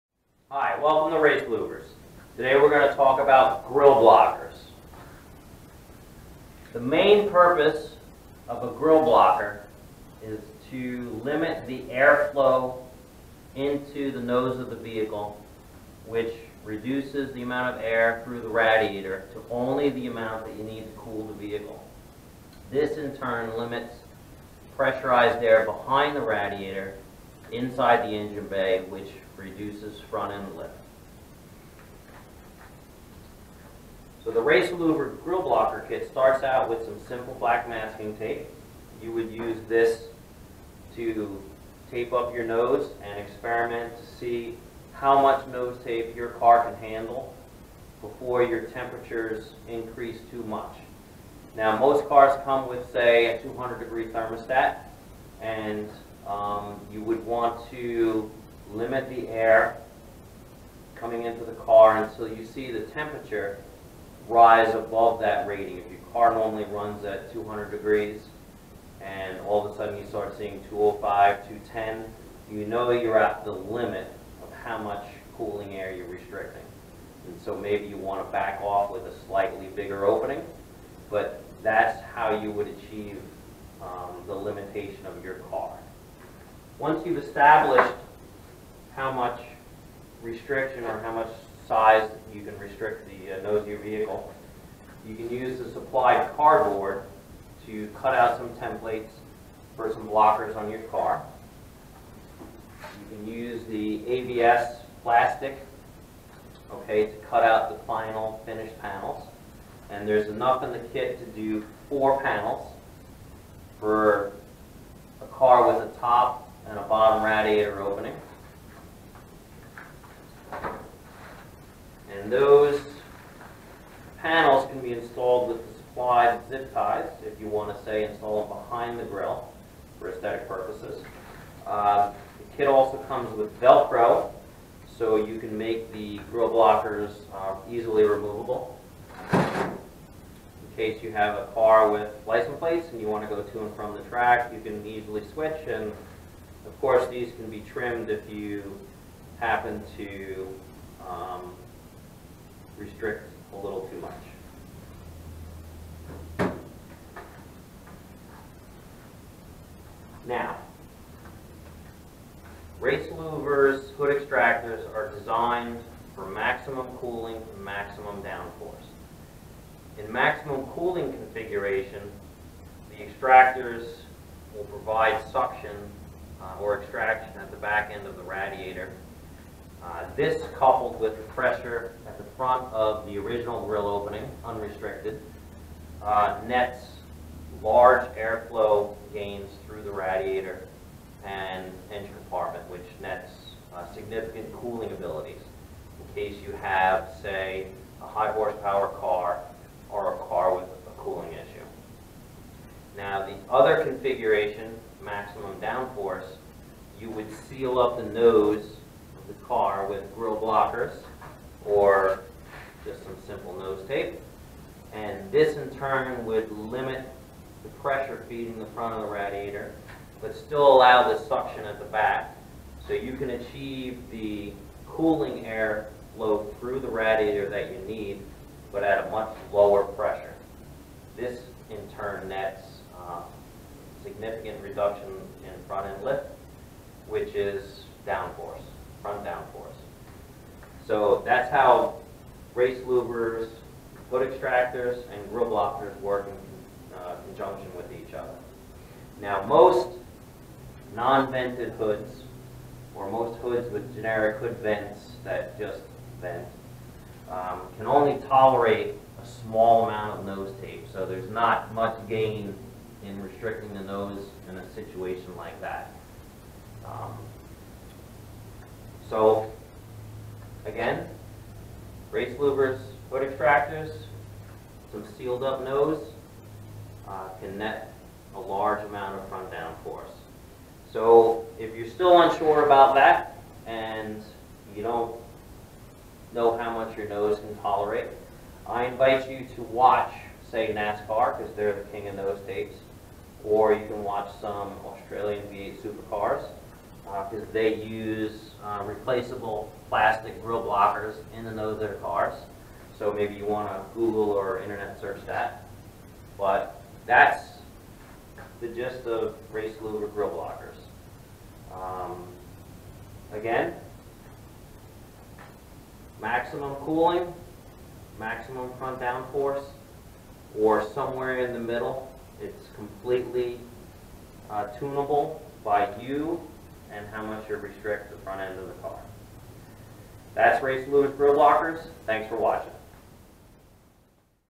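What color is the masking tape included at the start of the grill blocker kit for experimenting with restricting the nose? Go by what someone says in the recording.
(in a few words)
black.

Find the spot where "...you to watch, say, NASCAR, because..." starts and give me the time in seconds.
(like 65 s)
289 s.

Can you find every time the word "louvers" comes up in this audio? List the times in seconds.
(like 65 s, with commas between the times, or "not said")
1 s, 34 s, 163 s, 242 s, 272 s, 309 s, 330 s.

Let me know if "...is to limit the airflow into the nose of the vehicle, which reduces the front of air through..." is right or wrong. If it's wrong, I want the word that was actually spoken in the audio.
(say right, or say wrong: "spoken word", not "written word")
wrong: "amount", not "front".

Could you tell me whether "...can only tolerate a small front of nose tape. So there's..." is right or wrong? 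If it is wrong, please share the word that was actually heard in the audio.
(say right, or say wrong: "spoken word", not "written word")
wrong: "amount", not "front".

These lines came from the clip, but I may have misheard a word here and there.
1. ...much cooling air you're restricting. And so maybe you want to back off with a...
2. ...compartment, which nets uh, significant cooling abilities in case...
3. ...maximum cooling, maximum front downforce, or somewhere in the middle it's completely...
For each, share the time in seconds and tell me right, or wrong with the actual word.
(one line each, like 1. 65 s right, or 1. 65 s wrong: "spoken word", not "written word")
1. 74 s right
2. 192 s right
3. 316 s right.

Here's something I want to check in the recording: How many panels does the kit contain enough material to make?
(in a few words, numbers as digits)
4.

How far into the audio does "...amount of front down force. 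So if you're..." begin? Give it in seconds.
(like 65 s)
278 s.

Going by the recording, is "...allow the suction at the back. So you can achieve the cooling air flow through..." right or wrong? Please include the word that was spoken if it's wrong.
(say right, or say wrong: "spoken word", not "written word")
right.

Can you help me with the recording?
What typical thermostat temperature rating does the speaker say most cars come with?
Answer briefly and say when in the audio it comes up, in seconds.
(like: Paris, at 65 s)
200 degrees, at 53 s.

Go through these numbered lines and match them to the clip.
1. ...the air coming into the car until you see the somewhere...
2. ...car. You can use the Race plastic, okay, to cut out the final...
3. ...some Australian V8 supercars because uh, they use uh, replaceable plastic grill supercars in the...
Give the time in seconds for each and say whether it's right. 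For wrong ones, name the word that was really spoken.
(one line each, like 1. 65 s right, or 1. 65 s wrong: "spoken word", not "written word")
1. 59 s wrong: "temperature", not "somewhere"
2. 100 s wrong: "ABS", not "Race"
3. 294 s wrong: "blockers", not "supercars".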